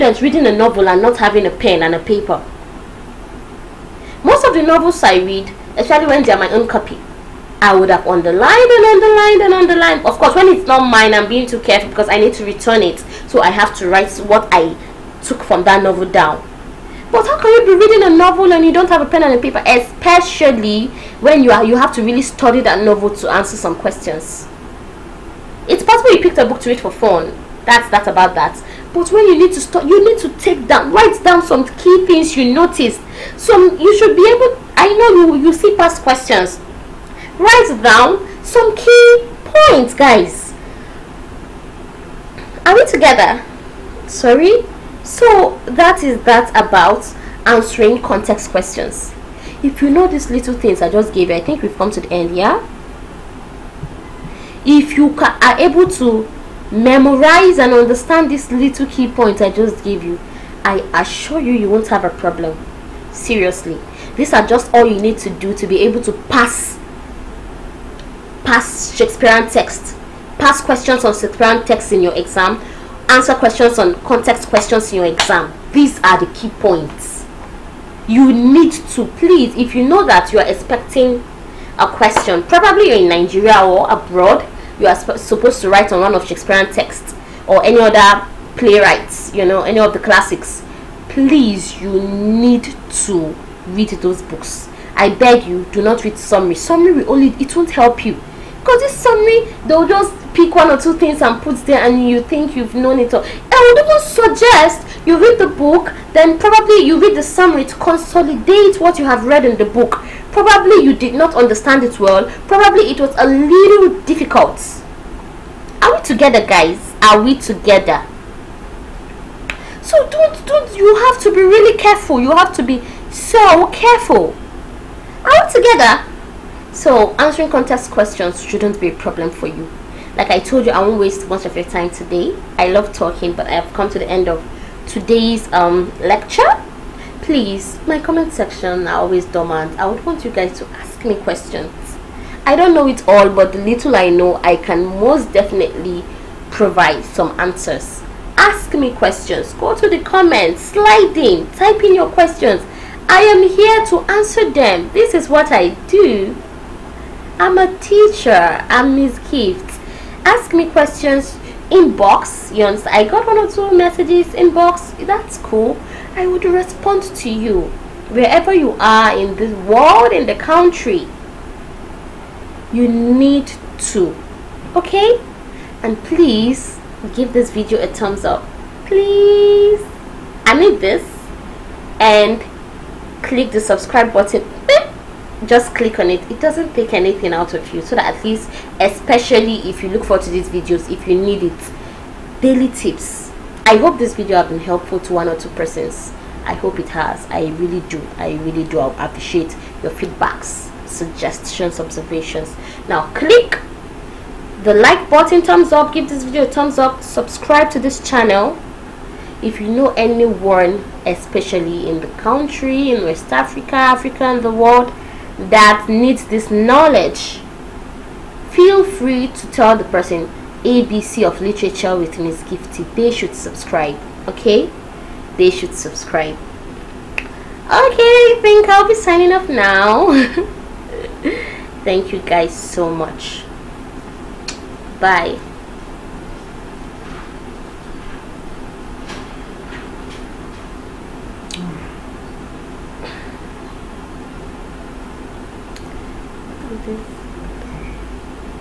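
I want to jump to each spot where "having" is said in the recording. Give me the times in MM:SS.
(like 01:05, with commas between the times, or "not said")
00:01.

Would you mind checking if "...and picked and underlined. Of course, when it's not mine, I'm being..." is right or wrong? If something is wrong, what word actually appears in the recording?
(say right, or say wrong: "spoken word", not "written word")
wrong: "underlined", not "picked".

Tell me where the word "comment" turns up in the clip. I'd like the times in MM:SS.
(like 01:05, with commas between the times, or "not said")
02:17, 02:30.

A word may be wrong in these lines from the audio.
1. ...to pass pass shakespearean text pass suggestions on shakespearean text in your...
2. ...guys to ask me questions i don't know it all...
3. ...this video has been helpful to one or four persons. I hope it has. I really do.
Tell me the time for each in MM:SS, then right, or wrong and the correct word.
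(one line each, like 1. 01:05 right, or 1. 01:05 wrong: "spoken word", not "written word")
1. 01:06 wrong: "questions", not "suggestions"
2. 02:20 right
3. 03:13 wrong: "two", not "four".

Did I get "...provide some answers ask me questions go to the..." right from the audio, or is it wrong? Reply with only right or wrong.
right.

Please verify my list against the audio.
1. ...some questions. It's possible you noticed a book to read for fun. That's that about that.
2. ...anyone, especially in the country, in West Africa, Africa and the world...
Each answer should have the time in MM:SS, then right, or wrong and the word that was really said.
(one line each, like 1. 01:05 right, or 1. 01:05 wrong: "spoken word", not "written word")
1. 00:23 wrong: "picked", not "noticed"
2. 03:29 right.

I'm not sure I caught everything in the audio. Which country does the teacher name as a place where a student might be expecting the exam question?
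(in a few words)
Nigeria.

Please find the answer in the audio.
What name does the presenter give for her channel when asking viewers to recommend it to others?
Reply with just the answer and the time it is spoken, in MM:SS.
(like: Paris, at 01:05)
ABC of Literature with Miss Gifty, at 03:40.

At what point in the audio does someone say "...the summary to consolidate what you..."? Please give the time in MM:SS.
01:47.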